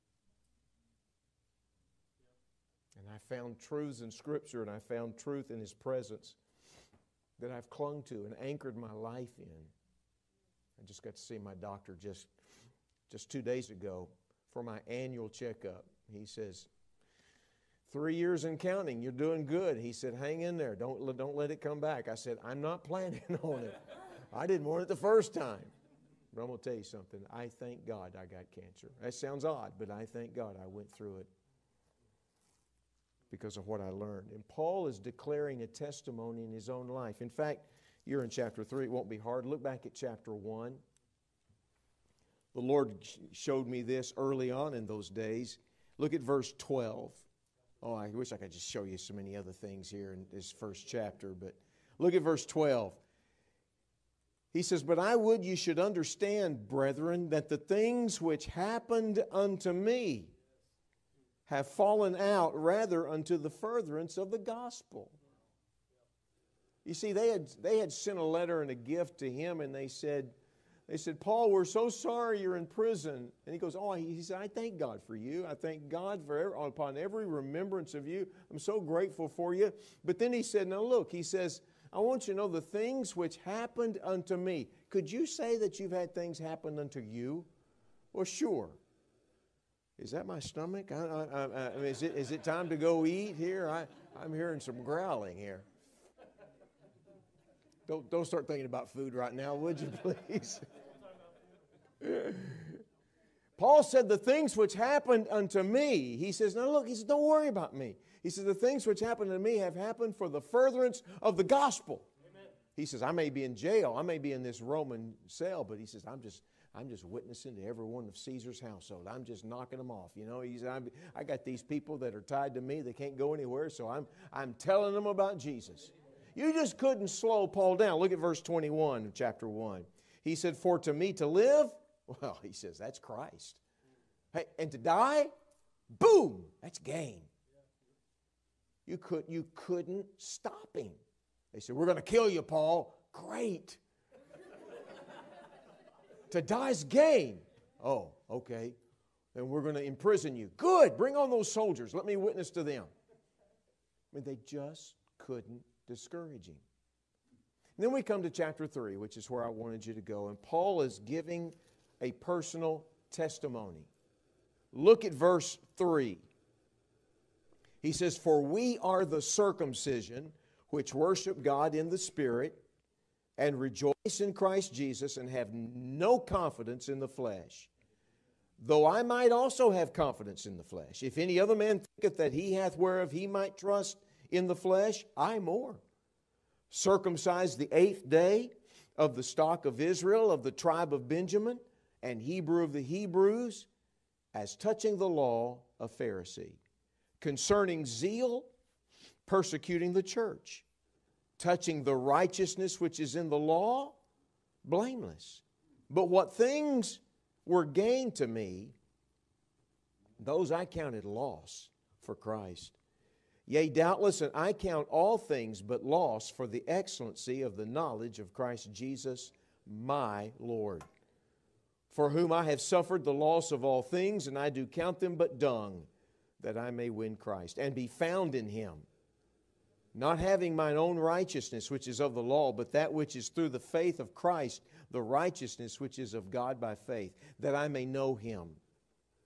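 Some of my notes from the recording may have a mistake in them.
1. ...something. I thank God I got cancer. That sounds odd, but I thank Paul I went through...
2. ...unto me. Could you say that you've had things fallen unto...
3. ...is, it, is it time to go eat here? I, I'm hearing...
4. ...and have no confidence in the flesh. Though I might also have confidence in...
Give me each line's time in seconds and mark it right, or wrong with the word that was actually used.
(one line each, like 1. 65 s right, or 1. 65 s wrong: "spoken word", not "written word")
1. 26 s wrong: "God", not "Paul"
2. 84 s wrong: "happen", not "fallen"
3. 91 s right
4. 175 s right.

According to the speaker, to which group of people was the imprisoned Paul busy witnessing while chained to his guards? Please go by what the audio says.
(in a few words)
Caesar's household.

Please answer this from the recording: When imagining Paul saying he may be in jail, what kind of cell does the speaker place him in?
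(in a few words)
Roman cell.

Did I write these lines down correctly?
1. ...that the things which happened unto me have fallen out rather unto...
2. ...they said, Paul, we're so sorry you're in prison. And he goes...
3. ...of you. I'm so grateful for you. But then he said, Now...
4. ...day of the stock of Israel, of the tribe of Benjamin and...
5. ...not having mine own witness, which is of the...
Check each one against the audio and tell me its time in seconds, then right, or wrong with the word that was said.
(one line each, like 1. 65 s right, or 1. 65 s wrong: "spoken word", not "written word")
1. 57 s right
2. 70 s right
3. 77 s right
4. 188 s right
5. 229 s wrong: "righteousness", not "witness".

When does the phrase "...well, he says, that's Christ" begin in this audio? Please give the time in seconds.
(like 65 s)
132 s.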